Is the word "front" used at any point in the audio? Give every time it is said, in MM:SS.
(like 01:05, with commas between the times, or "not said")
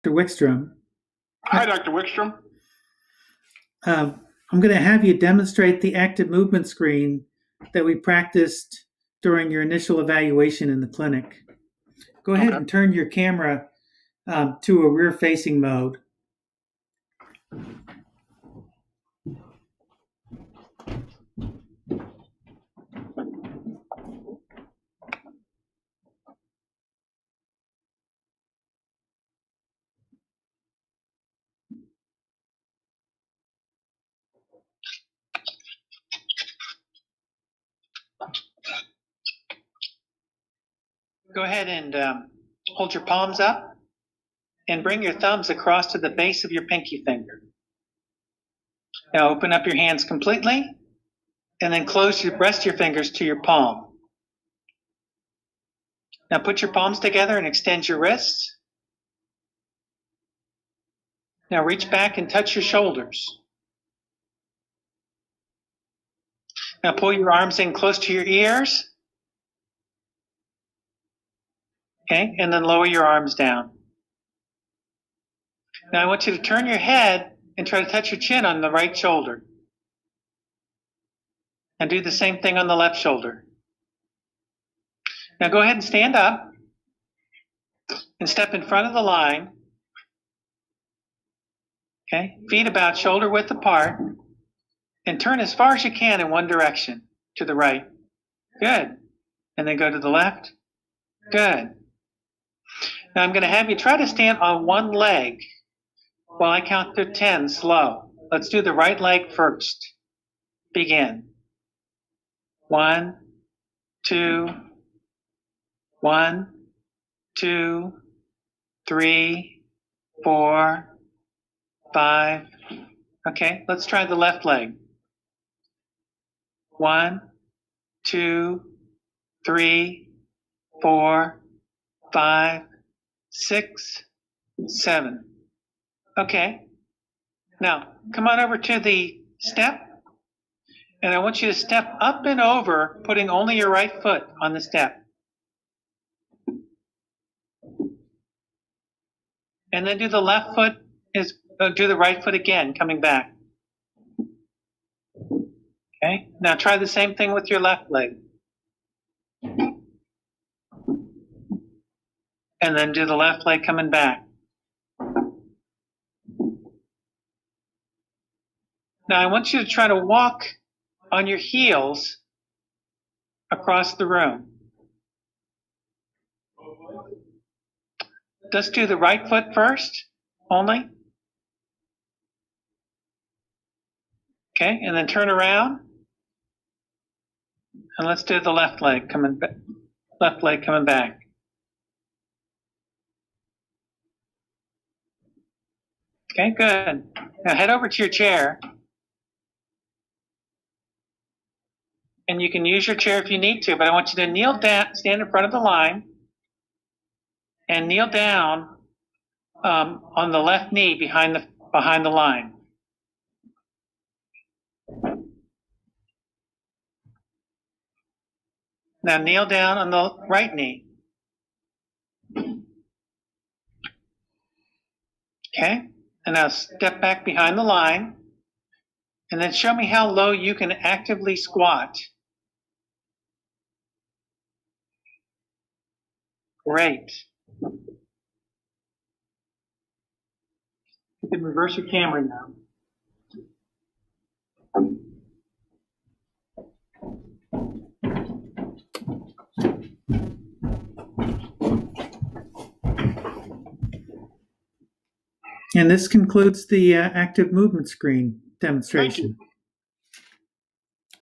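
01:28, 03:25.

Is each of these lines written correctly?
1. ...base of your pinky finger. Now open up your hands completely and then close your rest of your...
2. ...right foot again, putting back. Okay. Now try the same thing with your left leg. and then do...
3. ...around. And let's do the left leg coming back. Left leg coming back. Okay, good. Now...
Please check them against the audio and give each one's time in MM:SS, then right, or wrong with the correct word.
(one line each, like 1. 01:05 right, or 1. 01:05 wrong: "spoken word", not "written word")
1. 00:46 right
2. 02:31 wrong: "coming", not "putting"
3. 03:05 right.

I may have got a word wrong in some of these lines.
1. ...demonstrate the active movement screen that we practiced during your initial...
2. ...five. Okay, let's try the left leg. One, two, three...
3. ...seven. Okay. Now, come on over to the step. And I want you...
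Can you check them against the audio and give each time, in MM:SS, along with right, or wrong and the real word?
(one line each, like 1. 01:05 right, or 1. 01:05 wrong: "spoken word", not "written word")
1. 00:05 right
2. 02:01 right
3. 02:14 right.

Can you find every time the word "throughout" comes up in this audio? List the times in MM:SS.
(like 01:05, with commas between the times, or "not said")
not said.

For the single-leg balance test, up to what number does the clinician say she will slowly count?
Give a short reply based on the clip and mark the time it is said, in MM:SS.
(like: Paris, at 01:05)
10, at 01:47.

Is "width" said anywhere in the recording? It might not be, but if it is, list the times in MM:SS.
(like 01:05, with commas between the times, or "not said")
01:33.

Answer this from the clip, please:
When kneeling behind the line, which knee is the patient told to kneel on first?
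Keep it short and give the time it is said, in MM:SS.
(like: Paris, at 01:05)
left knee, at 03:30.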